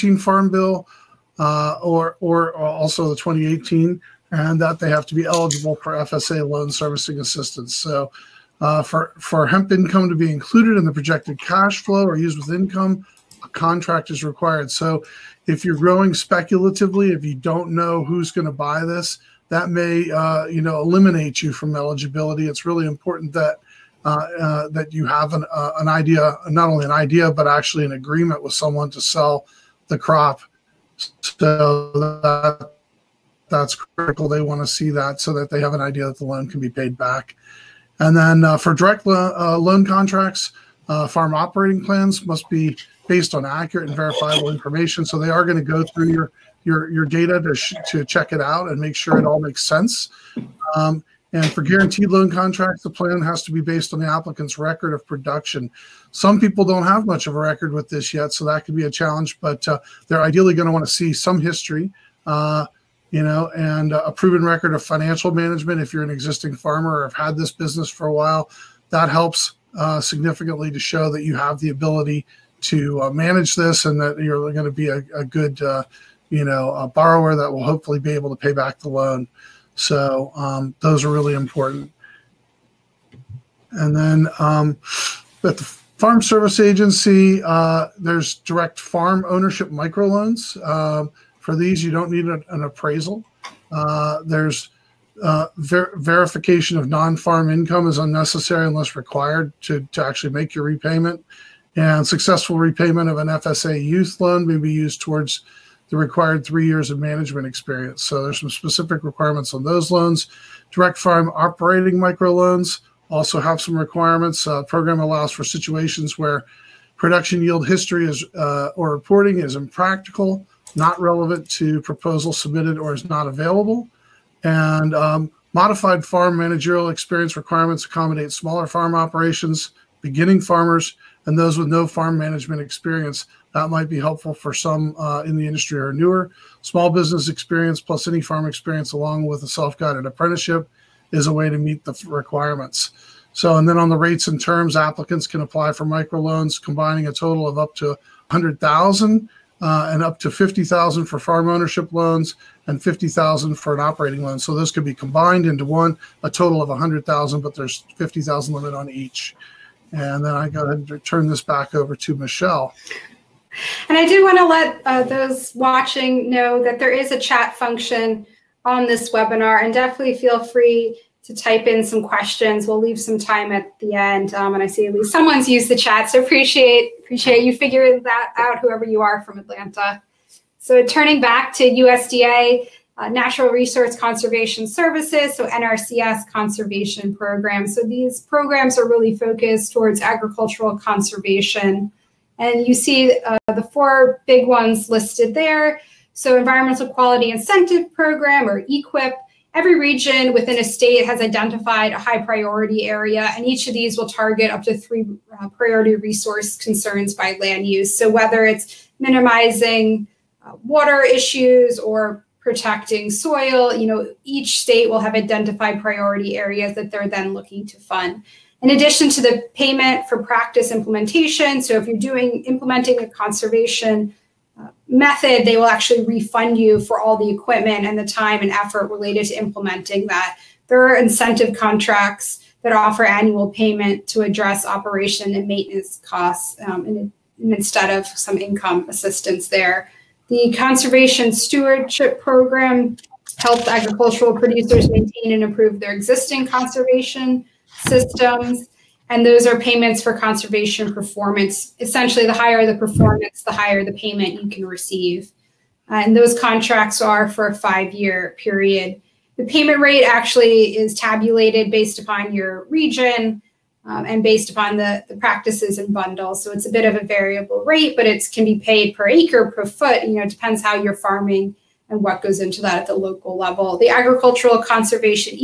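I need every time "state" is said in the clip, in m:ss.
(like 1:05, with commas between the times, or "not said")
3:20, 3:34.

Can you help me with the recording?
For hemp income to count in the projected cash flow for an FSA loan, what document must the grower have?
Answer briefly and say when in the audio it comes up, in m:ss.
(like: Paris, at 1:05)
A contract, at 0:13.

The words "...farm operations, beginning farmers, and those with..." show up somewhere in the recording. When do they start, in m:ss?
2:08.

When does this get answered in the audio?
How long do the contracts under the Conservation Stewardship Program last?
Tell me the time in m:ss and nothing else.
4:17.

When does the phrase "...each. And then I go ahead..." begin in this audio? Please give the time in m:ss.
2:38.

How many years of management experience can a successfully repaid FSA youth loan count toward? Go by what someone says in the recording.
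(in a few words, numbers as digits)
3.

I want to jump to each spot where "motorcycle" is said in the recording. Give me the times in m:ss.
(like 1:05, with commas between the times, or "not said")
not said.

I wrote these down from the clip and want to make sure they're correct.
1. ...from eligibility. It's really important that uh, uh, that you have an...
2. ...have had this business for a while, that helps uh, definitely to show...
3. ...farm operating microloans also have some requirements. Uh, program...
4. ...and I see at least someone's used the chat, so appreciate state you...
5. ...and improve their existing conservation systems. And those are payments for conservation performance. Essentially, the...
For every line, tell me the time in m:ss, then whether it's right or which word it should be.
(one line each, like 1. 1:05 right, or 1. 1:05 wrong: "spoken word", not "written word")
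1. 0:21 right
2. 1:07 wrong: "significantly", not "definitely"
3. 1:50 right
4. 2:54 wrong: "appreciate", not "state"
5. 4:05 right.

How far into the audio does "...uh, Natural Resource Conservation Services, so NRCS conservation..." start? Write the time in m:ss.
3:02.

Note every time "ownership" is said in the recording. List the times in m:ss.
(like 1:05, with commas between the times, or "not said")
1:29, 2:31.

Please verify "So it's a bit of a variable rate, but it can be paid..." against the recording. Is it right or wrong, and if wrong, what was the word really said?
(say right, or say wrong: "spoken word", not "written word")
right.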